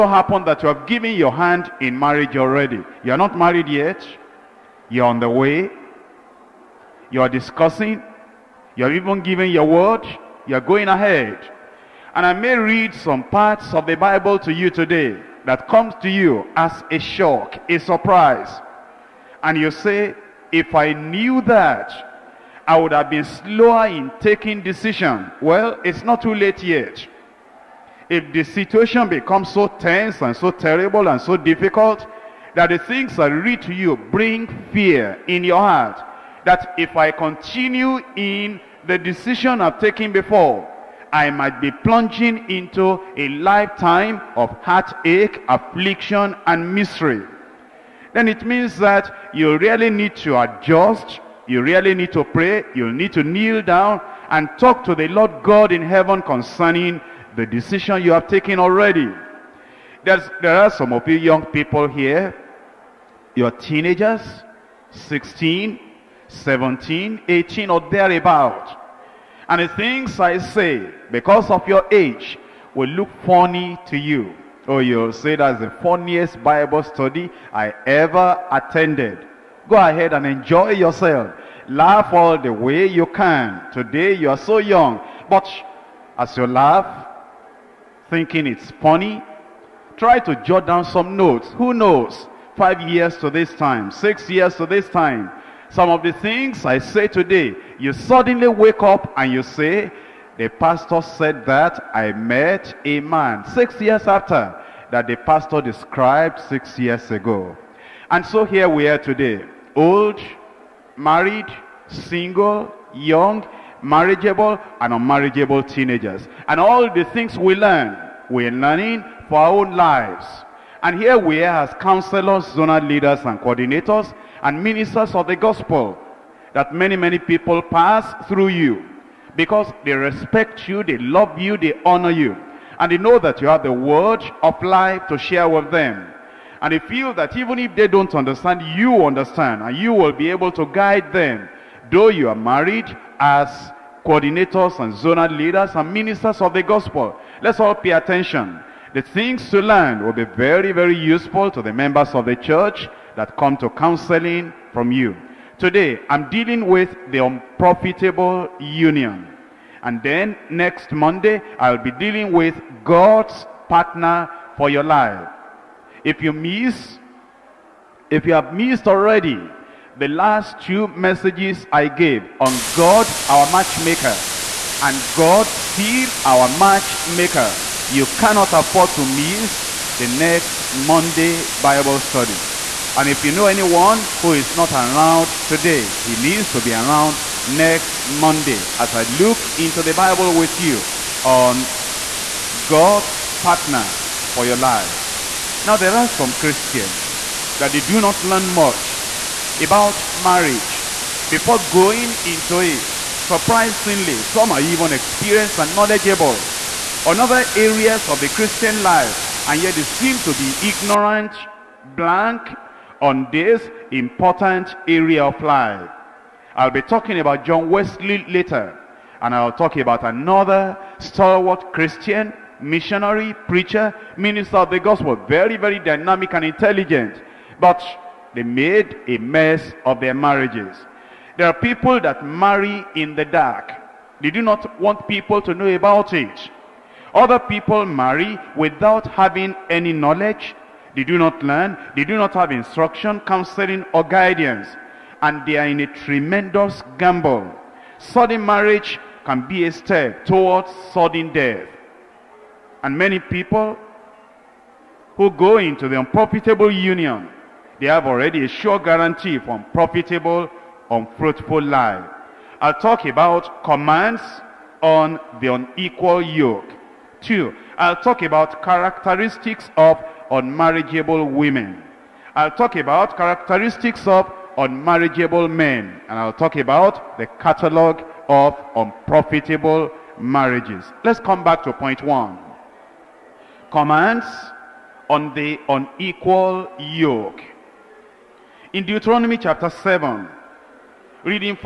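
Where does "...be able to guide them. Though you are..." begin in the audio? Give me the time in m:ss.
2:20.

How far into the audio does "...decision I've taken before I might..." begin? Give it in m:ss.
0:38.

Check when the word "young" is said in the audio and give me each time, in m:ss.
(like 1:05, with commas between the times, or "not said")
1:01, 1:24, 1:52.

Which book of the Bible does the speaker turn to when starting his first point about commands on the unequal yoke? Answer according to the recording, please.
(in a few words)
Deuteronomy.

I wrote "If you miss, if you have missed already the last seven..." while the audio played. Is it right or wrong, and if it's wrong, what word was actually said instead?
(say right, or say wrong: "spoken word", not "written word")
wrong: "two", not "seven".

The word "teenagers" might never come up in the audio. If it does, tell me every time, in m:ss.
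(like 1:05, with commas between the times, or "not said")
1:03, 1:55.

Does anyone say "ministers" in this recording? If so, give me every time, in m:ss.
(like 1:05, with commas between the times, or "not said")
2:04, 2:25, 3:44.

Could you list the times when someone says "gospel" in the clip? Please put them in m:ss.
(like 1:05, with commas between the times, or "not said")
2:05, 2:26, 3:44.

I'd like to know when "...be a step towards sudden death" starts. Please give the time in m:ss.
4:09.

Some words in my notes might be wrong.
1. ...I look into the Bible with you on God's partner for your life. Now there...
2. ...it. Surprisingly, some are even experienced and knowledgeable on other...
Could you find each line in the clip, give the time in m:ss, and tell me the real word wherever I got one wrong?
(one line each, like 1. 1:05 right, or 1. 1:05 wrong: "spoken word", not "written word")
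1. 3:08 right
2. 3:22 right.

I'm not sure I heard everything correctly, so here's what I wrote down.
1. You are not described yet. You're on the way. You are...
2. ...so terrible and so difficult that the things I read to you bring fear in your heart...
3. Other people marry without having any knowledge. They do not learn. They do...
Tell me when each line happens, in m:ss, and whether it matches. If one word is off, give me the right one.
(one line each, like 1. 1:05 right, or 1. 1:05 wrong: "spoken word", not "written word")
1. 0:03 wrong: "married", not "described"
2. 0:30 right
3. 3:57 right.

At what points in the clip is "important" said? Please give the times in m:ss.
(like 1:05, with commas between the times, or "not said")
3:33.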